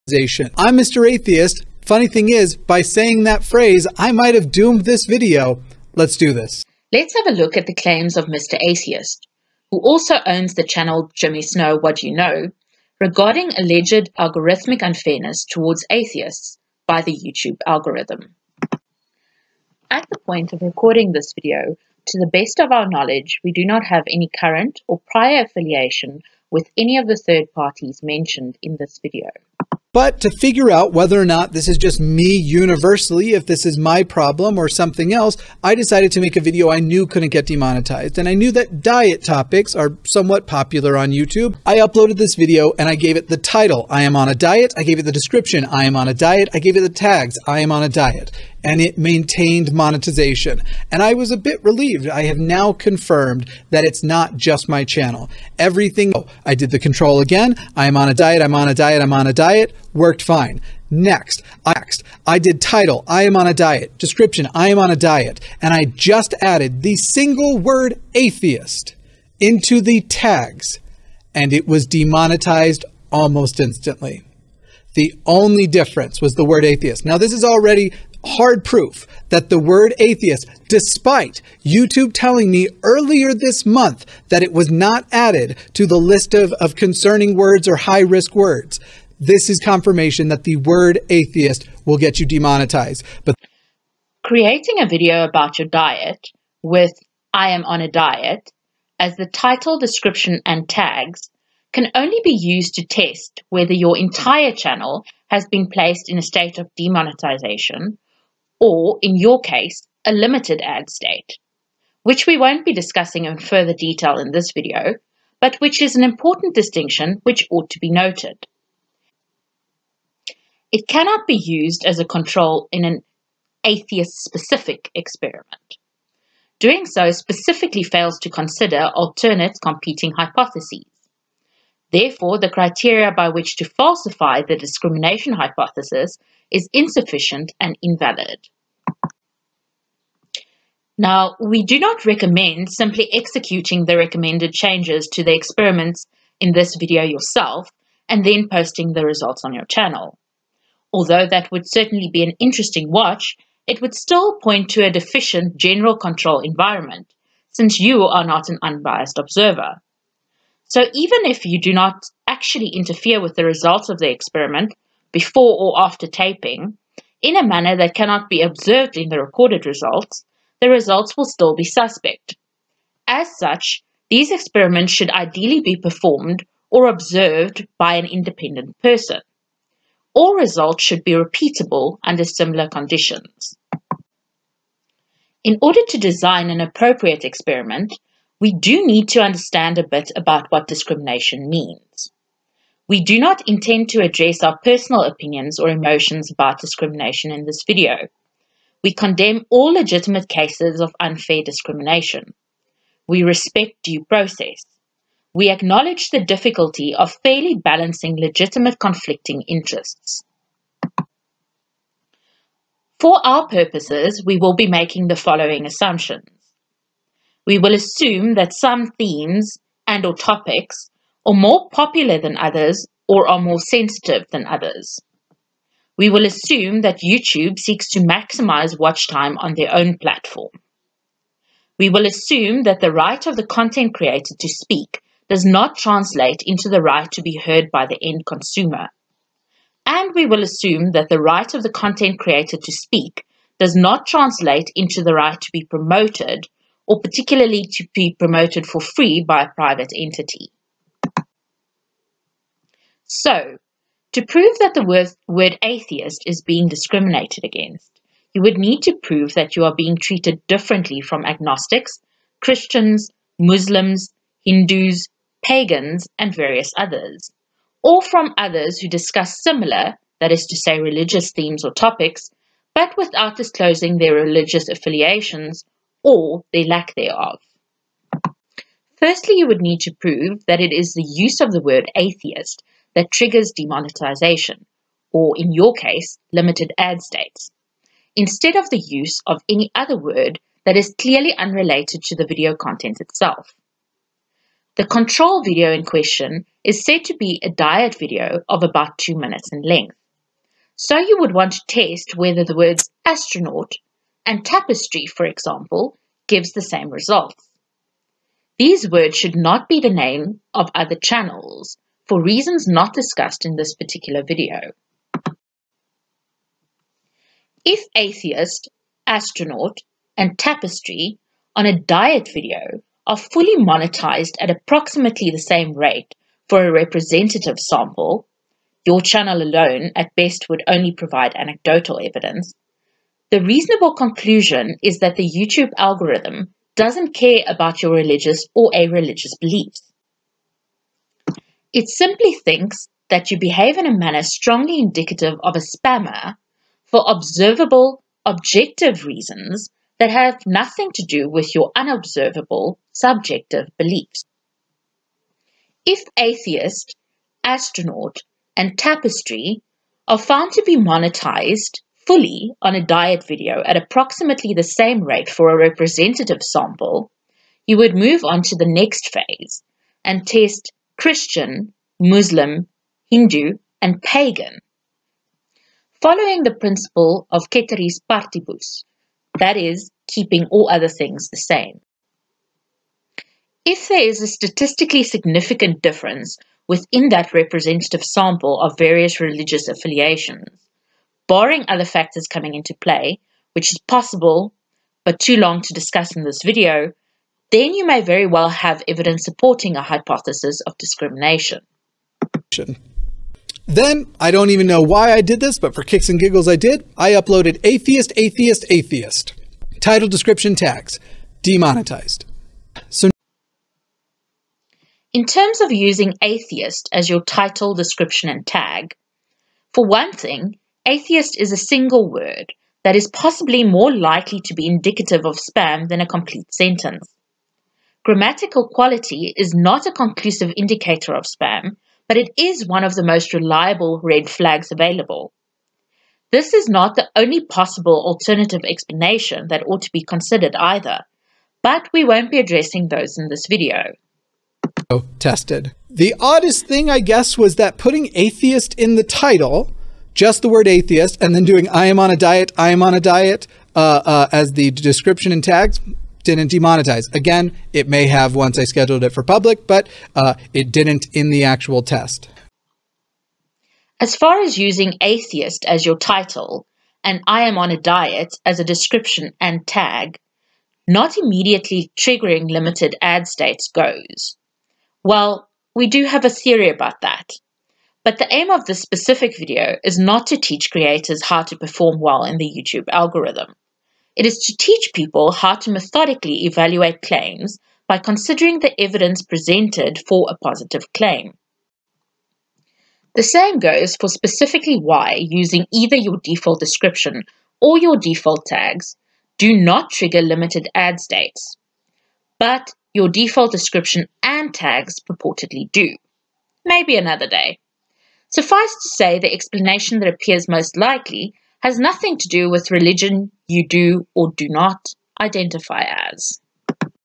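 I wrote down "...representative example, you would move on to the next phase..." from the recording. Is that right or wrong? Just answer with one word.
wrong.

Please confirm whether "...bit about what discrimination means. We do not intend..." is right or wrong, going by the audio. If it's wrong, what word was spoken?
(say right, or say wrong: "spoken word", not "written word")
right.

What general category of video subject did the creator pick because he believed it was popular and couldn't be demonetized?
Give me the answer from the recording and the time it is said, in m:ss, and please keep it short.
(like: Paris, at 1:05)
diet topics, at 0:38.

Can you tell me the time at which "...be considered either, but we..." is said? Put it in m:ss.
7:19.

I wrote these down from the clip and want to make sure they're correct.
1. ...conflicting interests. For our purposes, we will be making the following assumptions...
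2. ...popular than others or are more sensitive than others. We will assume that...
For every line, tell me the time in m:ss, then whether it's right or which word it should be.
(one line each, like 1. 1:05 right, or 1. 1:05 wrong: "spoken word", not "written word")
1. 3:28 right
2. 3:41 right.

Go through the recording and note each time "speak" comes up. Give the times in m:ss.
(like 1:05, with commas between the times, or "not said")
3:54, 4:02.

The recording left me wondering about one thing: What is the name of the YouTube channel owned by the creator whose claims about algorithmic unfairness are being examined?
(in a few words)
Jimmy Snow What You Know.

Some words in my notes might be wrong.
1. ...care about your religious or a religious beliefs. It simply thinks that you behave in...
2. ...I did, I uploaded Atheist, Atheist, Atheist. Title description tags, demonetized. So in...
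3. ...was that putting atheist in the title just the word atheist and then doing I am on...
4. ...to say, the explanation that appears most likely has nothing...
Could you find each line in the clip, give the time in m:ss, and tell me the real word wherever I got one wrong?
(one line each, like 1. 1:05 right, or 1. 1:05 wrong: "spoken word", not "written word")
1. 5:37 right
2. 6:46 right
3. 7:27 right
4. 8:28 right.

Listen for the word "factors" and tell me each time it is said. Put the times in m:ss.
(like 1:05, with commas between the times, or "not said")
6:31.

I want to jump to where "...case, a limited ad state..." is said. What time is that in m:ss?
1:49.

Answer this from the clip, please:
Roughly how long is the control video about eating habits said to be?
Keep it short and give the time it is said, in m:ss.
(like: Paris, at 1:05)
about 2 minutes, at 4:58.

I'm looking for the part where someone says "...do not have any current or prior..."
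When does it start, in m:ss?
0:23.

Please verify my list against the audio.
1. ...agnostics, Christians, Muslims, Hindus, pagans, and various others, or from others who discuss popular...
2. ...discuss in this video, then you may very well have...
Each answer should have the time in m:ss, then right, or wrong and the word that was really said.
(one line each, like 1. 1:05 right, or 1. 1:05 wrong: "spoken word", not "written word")
1. 4:21 wrong: "similar", not "popular"
2. 6:35 right.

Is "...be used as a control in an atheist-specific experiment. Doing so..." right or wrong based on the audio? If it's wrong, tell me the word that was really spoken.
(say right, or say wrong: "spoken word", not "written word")
right.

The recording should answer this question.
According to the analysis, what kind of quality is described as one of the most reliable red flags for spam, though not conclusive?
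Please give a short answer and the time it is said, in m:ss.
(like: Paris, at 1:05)
Grammatical quality, at 7:08.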